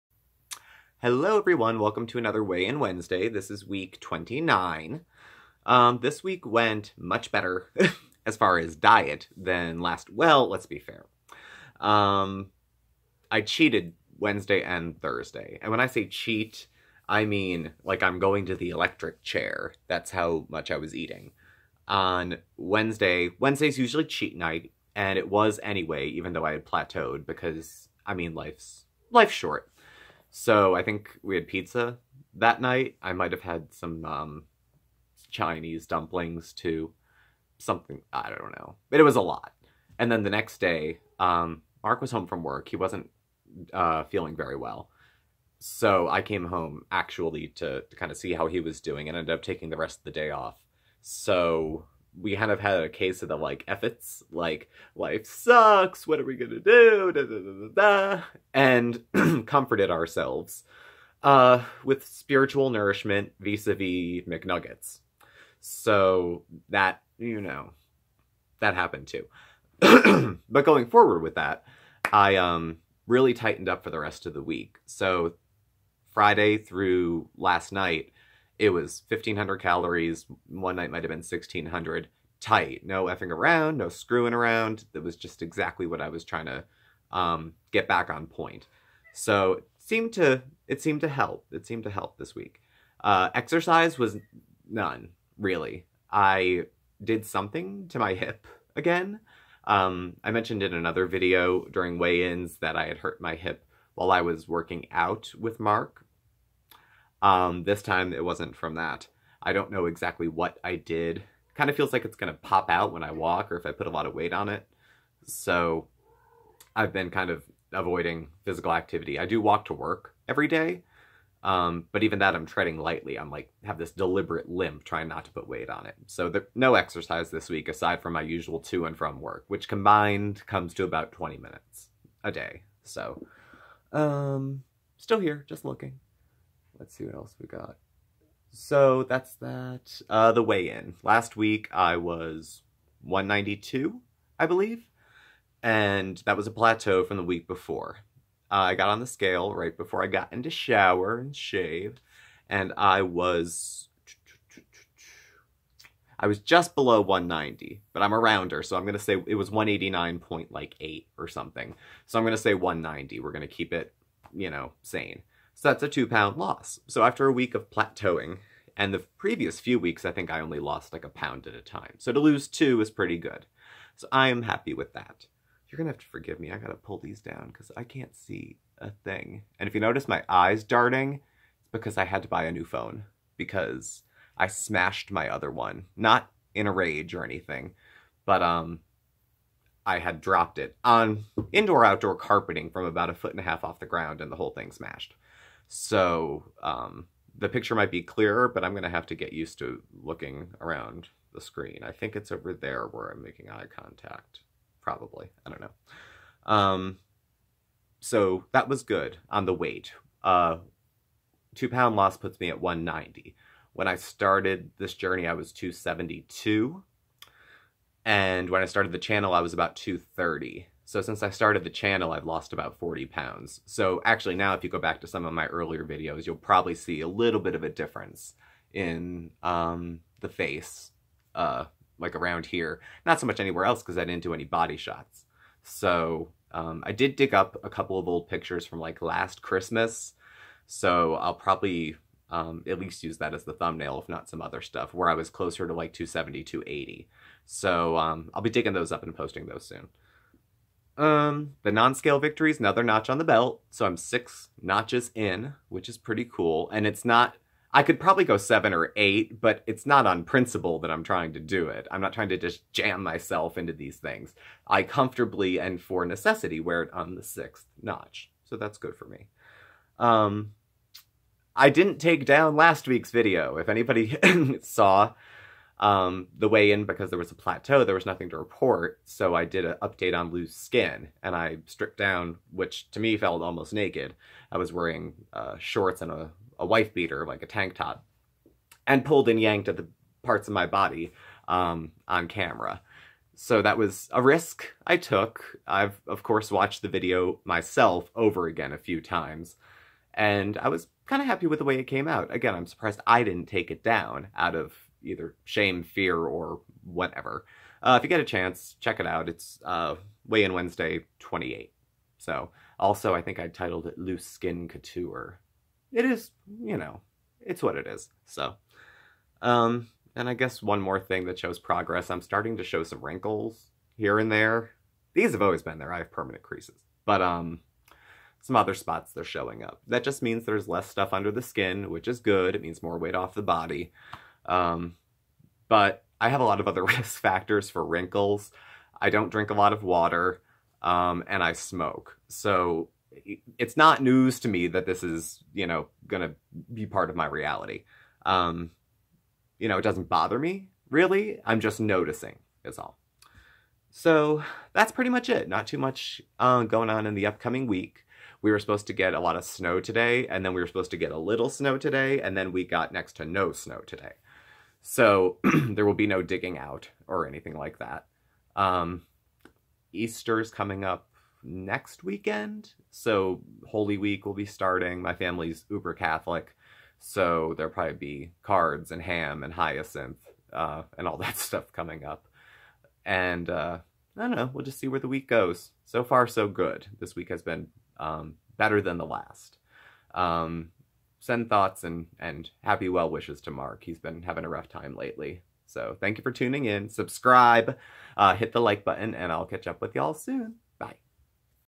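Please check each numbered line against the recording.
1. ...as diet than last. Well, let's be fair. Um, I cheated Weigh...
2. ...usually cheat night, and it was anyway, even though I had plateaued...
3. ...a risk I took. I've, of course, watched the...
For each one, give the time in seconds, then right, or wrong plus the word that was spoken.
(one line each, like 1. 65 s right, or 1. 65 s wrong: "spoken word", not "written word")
1. 8 s wrong: "Wednesday", not "Weigh"
2. 23 s right
3. 294 s right.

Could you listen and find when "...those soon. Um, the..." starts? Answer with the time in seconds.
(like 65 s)
249 s.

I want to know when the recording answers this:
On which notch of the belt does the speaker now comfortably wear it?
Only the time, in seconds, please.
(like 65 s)
267 s.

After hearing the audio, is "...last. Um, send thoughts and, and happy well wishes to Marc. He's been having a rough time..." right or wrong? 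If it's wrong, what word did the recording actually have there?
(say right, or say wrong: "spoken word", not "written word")
right.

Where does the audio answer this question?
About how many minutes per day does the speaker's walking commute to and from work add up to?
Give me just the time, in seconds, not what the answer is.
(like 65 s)
131 s.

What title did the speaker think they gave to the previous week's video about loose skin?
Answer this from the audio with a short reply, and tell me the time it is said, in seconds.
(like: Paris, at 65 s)
Loose Skin Couture, at 313 s.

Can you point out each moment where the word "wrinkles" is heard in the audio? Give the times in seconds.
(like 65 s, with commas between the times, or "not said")
323 s, 337 s.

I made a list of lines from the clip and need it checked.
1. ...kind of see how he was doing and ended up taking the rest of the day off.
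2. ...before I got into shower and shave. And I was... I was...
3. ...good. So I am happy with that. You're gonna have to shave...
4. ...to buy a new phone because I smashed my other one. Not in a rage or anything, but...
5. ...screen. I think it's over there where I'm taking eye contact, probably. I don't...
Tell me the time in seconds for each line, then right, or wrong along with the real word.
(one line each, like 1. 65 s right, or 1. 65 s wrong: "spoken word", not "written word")
1. 47 s right
2. 149 s right
3. 173 s wrong: "forgive", not "shave"
4. 182 s right
5. 201 s wrong: "making", not "taking".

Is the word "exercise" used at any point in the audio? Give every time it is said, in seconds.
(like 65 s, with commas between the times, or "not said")
93 s, 126 s.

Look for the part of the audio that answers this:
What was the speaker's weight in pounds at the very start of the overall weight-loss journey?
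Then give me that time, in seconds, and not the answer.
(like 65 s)
215 s.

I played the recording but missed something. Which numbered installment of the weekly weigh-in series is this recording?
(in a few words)
29.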